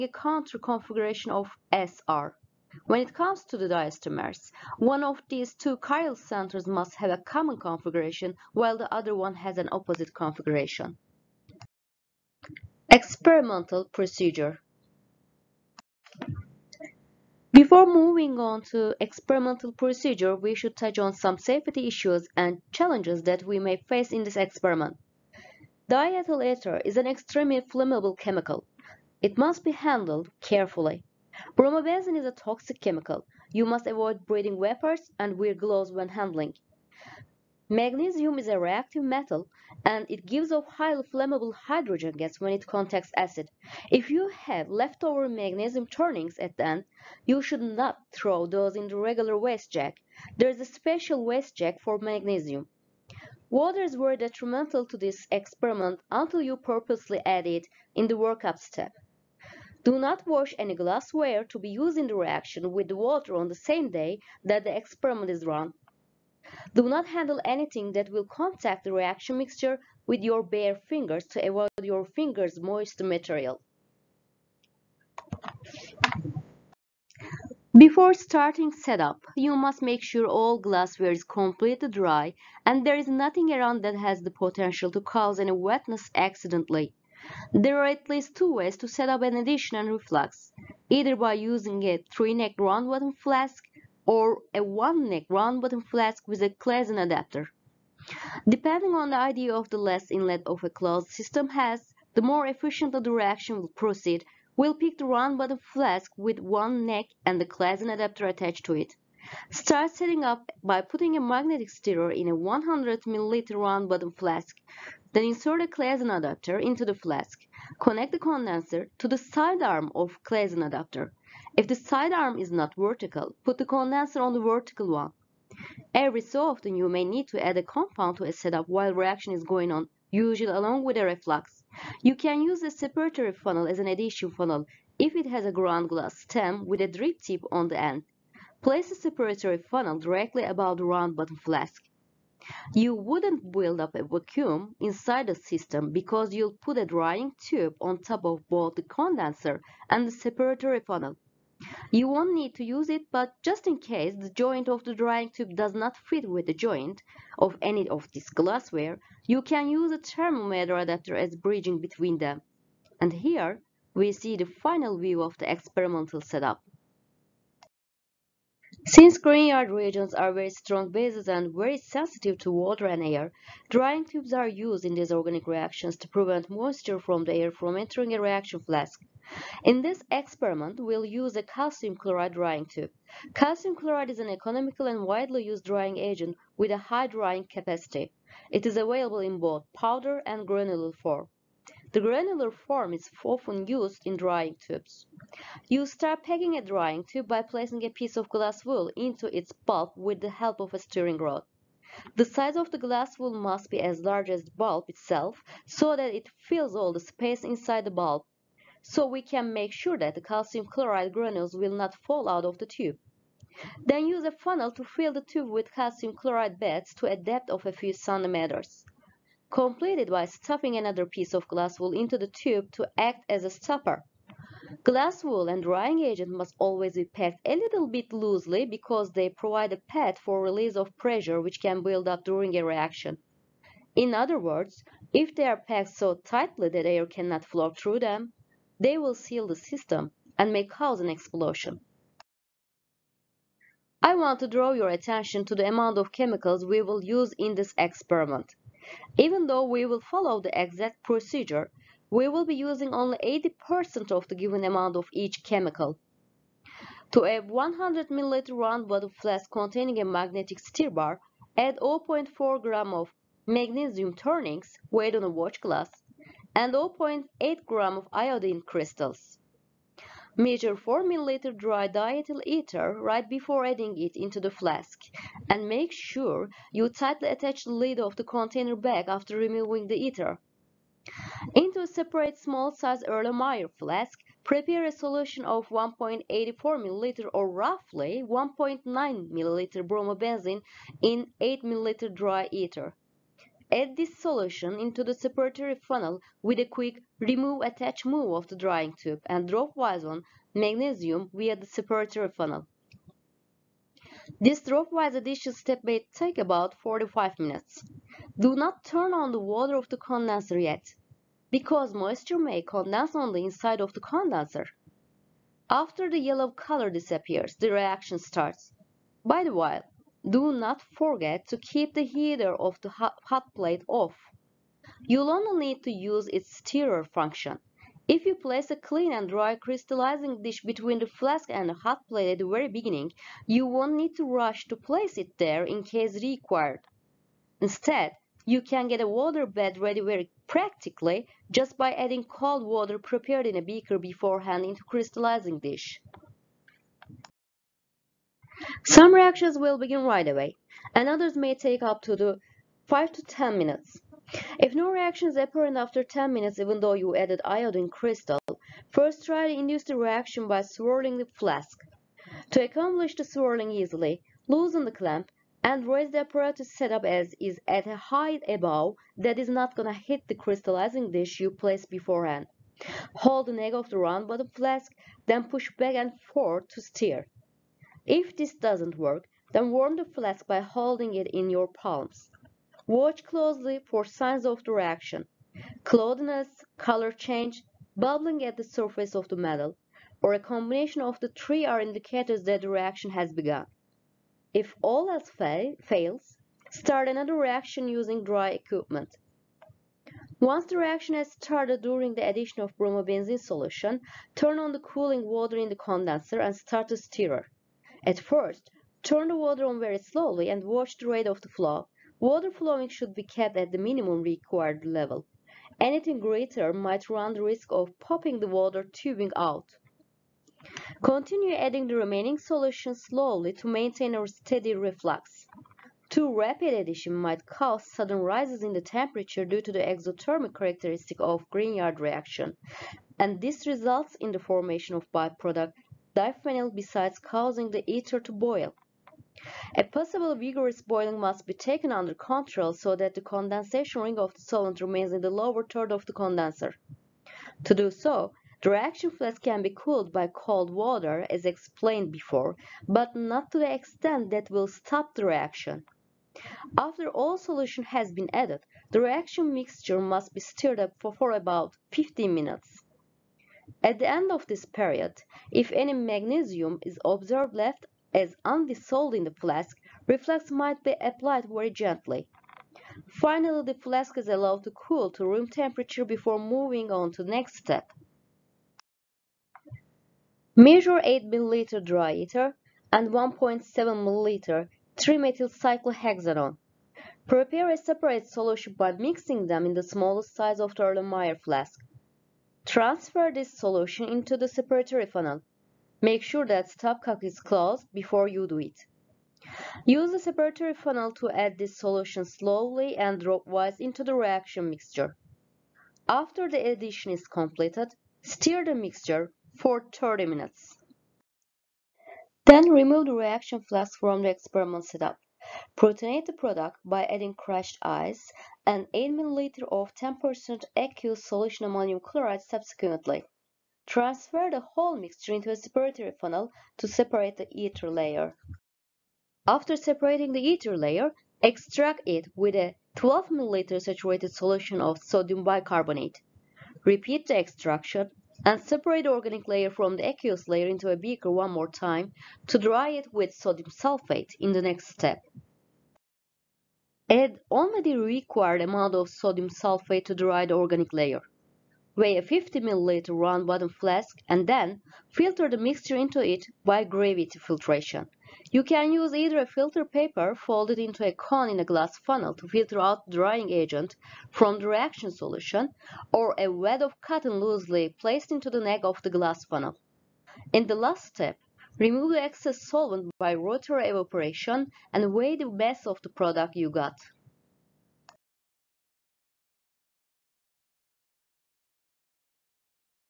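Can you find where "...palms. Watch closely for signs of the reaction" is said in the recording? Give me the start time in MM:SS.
06:21.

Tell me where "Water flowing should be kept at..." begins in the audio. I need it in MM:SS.
06:52.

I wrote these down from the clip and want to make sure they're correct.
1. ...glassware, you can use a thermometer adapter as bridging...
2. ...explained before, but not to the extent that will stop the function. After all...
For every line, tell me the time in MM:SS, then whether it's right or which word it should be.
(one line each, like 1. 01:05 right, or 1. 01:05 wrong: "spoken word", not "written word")
1. 02:38 right
2. 07:31 wrong: "reaction", not "function".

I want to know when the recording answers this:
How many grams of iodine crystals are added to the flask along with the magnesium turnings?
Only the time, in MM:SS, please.
04:26.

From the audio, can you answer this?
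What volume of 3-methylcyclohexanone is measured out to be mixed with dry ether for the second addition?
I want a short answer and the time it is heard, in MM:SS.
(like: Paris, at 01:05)
1.7 ml, at 08:03.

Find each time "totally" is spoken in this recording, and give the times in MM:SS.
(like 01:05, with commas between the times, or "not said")
not said.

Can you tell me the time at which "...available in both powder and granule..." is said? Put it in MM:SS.
03:08.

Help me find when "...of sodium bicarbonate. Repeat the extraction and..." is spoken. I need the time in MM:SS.
08:54.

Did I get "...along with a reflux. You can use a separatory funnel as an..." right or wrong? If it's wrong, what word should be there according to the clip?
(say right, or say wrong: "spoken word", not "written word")
right.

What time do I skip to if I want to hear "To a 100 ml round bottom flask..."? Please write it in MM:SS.
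04:17.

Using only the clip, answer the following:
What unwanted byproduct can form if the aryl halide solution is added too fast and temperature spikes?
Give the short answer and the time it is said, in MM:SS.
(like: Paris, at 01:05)
diphenyl, at 07:16.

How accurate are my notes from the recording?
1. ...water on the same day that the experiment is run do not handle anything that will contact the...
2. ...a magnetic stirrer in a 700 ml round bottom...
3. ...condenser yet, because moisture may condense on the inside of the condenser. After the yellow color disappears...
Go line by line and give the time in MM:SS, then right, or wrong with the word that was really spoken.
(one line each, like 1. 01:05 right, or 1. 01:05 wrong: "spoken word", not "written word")
1. 01:02 right
2. 01:51 wrong: "100", not "700"
3. 05:09 right.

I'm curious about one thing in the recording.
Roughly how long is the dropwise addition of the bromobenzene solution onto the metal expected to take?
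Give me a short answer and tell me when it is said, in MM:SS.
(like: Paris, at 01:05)
45 minutes, at 05:06.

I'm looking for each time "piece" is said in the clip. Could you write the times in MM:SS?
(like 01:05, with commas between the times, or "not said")
03:17, 03:41.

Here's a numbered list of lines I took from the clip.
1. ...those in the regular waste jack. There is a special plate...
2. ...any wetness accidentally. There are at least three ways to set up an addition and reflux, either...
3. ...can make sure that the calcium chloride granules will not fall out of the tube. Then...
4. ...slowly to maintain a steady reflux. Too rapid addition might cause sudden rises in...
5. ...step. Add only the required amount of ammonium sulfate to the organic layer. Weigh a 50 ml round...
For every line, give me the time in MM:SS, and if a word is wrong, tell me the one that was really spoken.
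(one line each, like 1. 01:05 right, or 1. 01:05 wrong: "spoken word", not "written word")
1. 00:48 wrong: "waste", not "plate"
2. 01:25 wrong: "two", not "three"
3. 03:29 right
4. 07:02 right
5. 09:04 wrong: "sodium", not "ammonium".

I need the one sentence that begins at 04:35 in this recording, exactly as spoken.
And make sure you tightly attach the lid of the container back after removing the ether.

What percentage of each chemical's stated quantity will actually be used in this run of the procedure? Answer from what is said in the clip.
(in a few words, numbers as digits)
80%.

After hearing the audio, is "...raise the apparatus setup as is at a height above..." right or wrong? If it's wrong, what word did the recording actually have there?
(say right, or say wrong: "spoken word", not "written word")
right.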